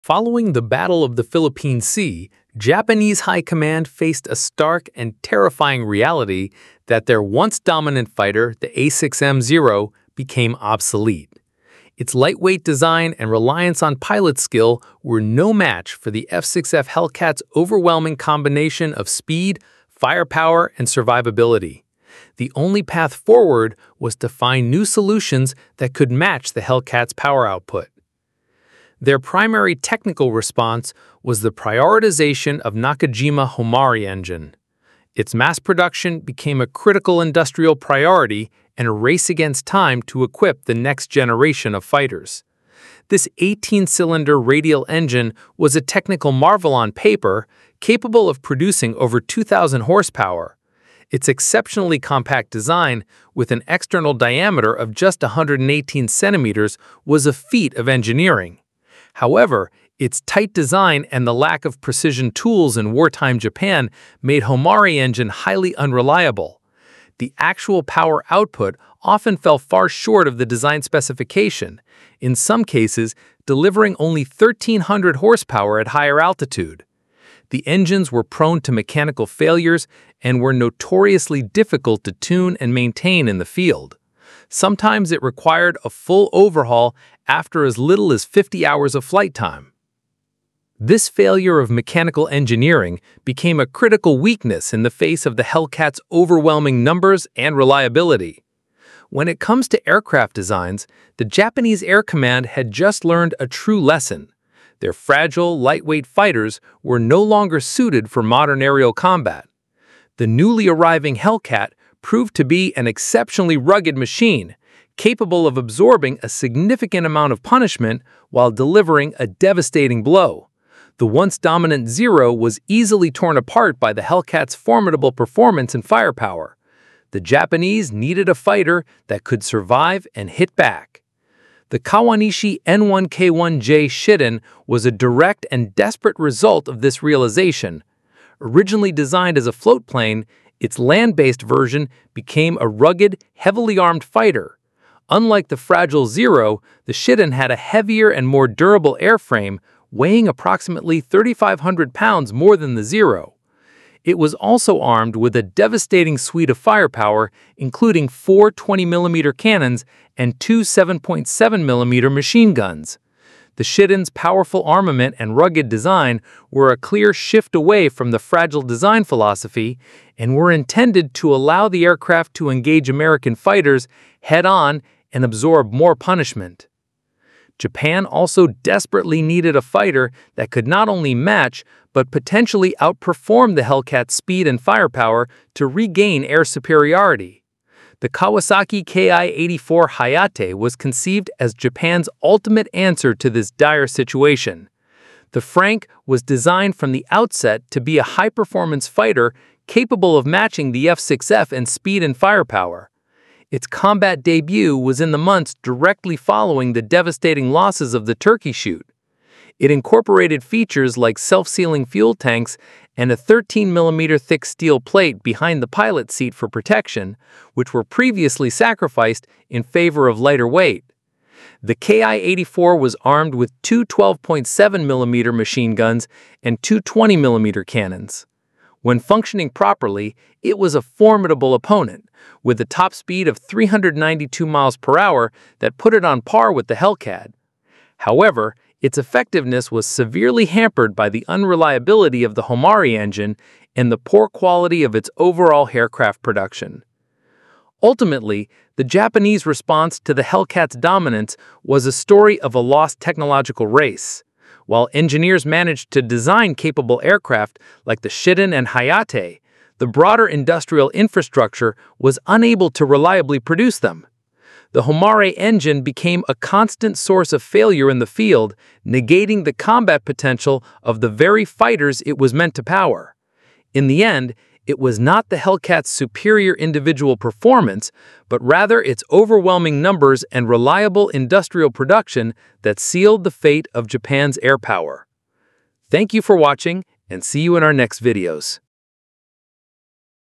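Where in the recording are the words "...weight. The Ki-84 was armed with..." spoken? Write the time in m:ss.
3:40.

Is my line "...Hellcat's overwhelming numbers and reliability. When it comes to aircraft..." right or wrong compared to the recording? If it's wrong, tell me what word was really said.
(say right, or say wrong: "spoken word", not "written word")
right.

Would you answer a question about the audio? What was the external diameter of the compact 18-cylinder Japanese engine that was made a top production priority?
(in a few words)
118 centimeters.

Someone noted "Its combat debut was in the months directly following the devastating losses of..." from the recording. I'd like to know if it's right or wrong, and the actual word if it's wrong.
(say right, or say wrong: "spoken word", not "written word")
right.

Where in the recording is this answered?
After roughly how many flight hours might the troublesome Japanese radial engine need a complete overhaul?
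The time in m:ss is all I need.
1:28.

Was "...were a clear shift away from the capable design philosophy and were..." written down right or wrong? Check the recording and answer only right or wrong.
wrong.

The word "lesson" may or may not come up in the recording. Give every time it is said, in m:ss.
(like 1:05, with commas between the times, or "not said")
1:43.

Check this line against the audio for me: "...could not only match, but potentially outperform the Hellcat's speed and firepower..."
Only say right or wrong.
right.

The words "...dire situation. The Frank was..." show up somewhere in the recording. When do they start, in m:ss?
3:13.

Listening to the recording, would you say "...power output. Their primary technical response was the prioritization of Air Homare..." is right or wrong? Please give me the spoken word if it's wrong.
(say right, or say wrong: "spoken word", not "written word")
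wrong: "Nakajima", not "Air".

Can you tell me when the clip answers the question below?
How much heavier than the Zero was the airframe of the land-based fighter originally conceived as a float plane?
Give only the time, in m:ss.
2:31.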